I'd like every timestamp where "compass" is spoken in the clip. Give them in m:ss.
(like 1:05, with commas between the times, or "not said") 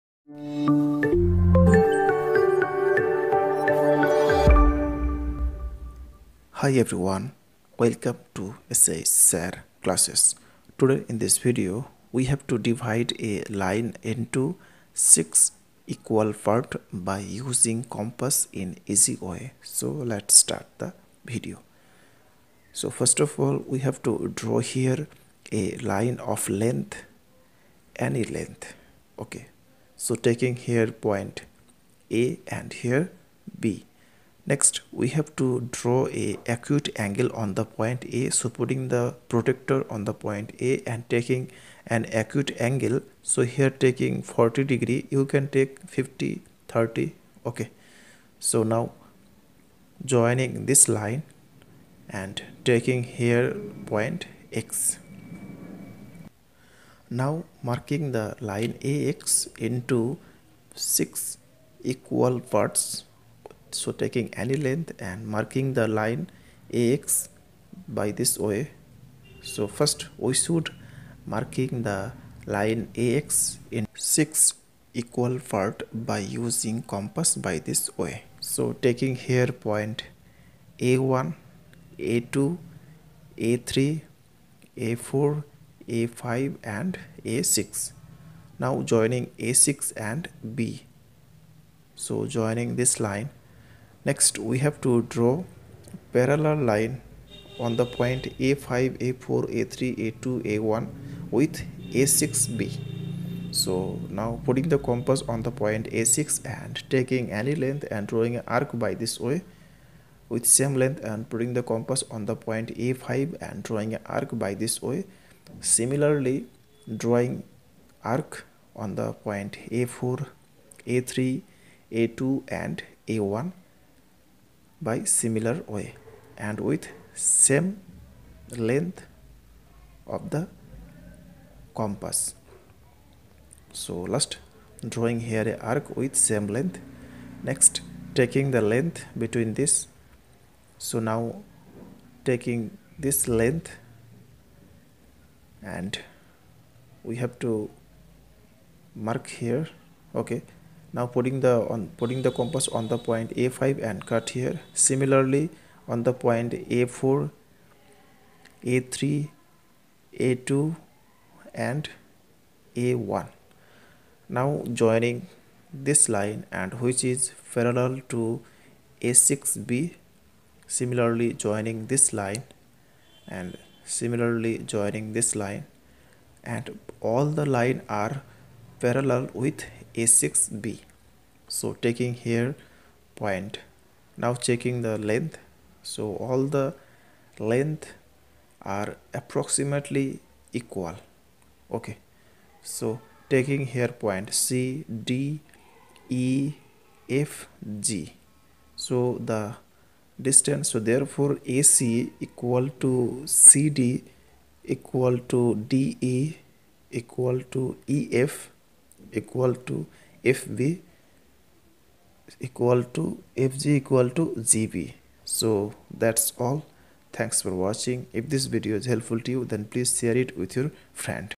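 0:17, 1:16, 1:44, 1:51, 2:11, 2:32.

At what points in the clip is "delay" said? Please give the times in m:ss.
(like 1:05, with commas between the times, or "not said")
not said.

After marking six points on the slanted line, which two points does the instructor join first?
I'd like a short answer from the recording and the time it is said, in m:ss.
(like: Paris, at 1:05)
A6 and B, at 1:29.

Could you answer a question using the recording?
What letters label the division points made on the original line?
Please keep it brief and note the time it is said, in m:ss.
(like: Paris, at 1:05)
C, D, E, F, G, at 3:14.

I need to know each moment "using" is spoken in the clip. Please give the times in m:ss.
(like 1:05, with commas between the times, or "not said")
0:17, 1:16.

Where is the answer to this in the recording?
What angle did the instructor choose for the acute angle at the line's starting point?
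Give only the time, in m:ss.
0:44.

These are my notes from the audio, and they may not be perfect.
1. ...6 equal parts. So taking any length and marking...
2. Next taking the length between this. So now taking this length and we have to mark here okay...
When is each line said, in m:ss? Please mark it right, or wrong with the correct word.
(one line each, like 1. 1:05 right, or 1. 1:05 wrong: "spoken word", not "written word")
1. 1:00 right
2. 2:17 right.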